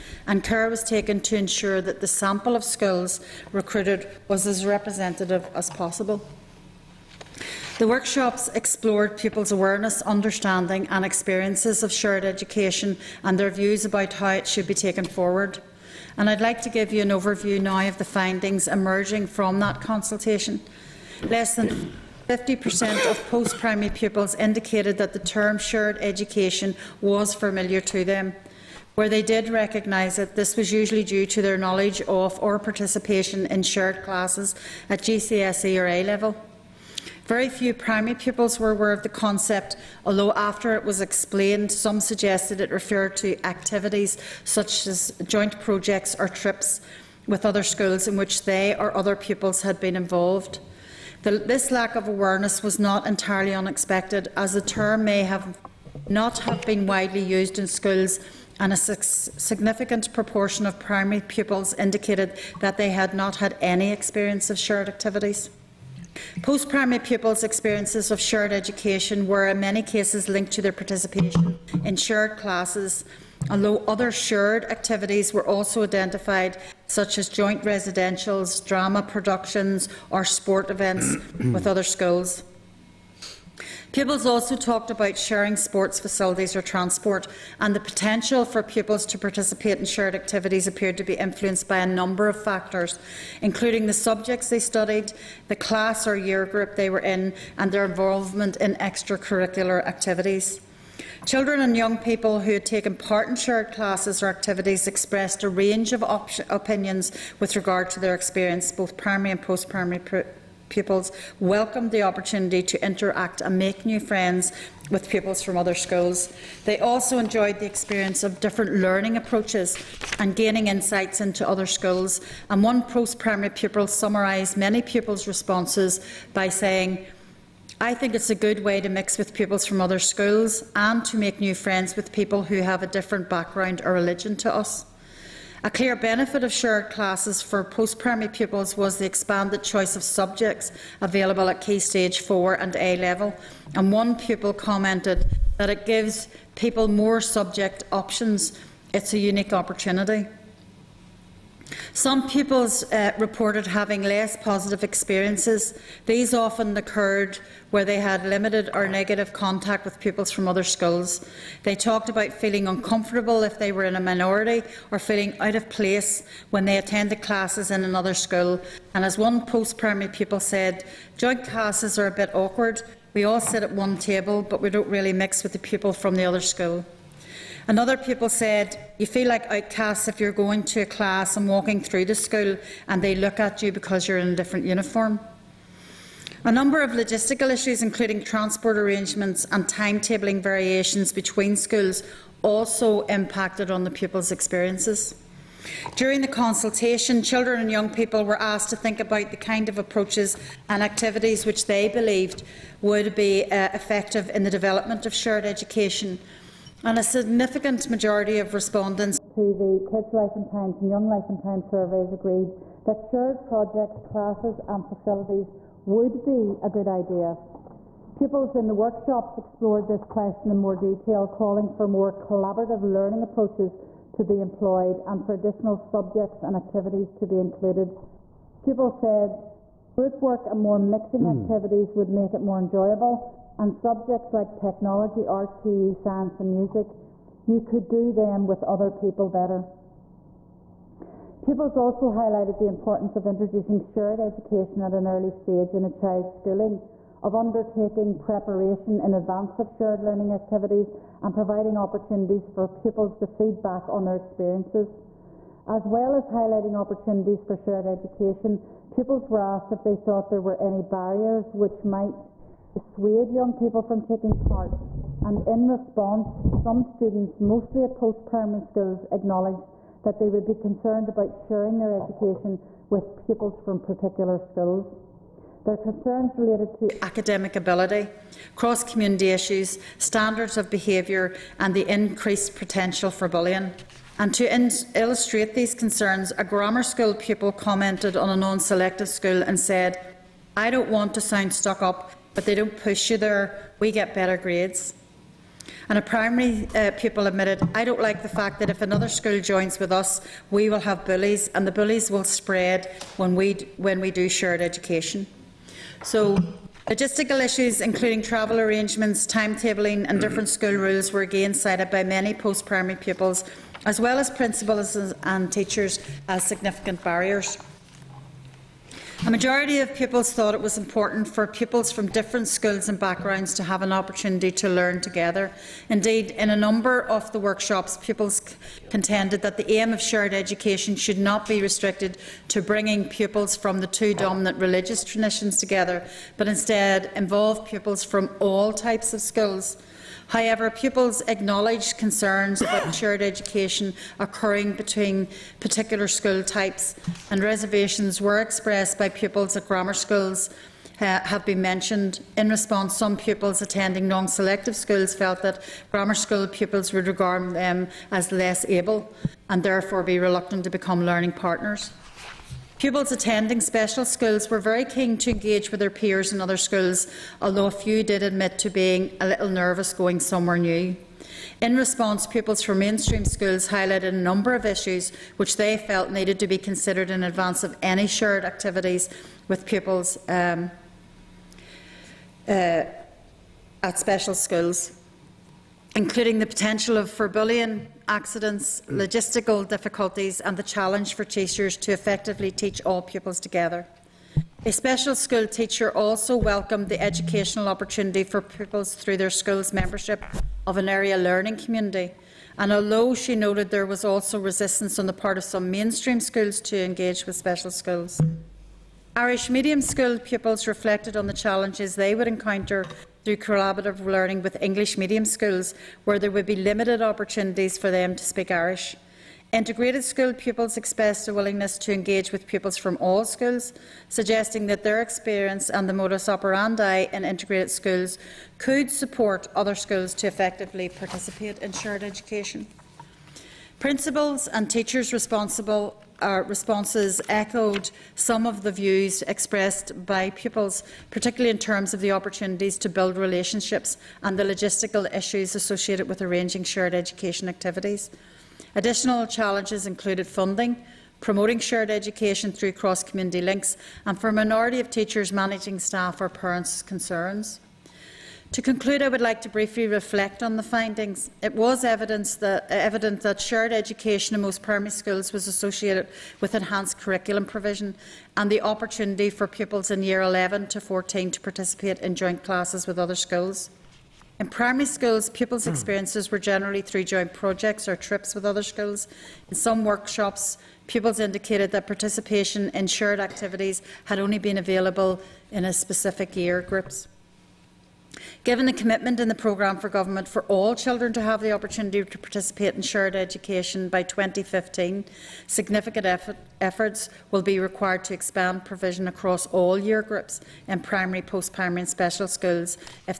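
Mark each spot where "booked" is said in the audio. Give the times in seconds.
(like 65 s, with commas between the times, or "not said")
not said.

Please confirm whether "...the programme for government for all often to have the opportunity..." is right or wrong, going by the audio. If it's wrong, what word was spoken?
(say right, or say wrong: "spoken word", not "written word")
wrong: "children", not "often".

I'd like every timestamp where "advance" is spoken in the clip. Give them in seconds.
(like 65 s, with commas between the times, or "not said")
249 s, 377 s.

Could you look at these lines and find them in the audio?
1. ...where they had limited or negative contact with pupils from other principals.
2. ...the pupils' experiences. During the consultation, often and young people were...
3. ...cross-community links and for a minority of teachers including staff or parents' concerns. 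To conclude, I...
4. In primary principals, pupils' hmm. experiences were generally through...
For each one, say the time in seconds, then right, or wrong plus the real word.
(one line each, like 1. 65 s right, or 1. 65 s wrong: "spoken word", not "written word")
1. 157 s wrong: "schools", not "principals"
2. 193 s wrong: "children", not "often"
3. 452 s wrong: "managing", not "including"
4. 474 s wrong: "schools", not "principals".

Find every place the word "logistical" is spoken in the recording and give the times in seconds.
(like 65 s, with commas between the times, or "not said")
186 s, 306 s, 388 s, 444 s.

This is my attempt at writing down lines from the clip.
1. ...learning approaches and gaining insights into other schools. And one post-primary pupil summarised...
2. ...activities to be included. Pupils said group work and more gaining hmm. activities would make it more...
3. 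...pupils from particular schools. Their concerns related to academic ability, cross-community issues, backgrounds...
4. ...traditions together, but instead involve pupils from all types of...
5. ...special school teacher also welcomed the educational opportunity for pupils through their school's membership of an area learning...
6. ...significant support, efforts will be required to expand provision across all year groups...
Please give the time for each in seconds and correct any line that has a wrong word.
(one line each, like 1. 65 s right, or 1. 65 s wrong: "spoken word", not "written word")
1. 118 s right
2. 226 s wrong: "mixing", not "gaining"
3. 273 s wrong: "standards", not "backgrounds"
4. 335 s right
5. 394 s right
6. 495 s wrong: "effort", not "support".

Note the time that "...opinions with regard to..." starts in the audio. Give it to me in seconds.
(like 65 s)
106 s.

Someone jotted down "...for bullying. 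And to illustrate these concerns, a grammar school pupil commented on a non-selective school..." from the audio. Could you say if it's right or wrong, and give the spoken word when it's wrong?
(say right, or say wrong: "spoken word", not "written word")
right.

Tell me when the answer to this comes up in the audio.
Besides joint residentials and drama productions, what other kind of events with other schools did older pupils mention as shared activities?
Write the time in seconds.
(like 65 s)
80 s.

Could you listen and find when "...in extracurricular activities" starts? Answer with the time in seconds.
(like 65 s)
98 s.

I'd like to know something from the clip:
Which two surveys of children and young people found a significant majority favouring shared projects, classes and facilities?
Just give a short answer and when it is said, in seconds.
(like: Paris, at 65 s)
Kids Life and Times and Young Life and Times, at 209 s.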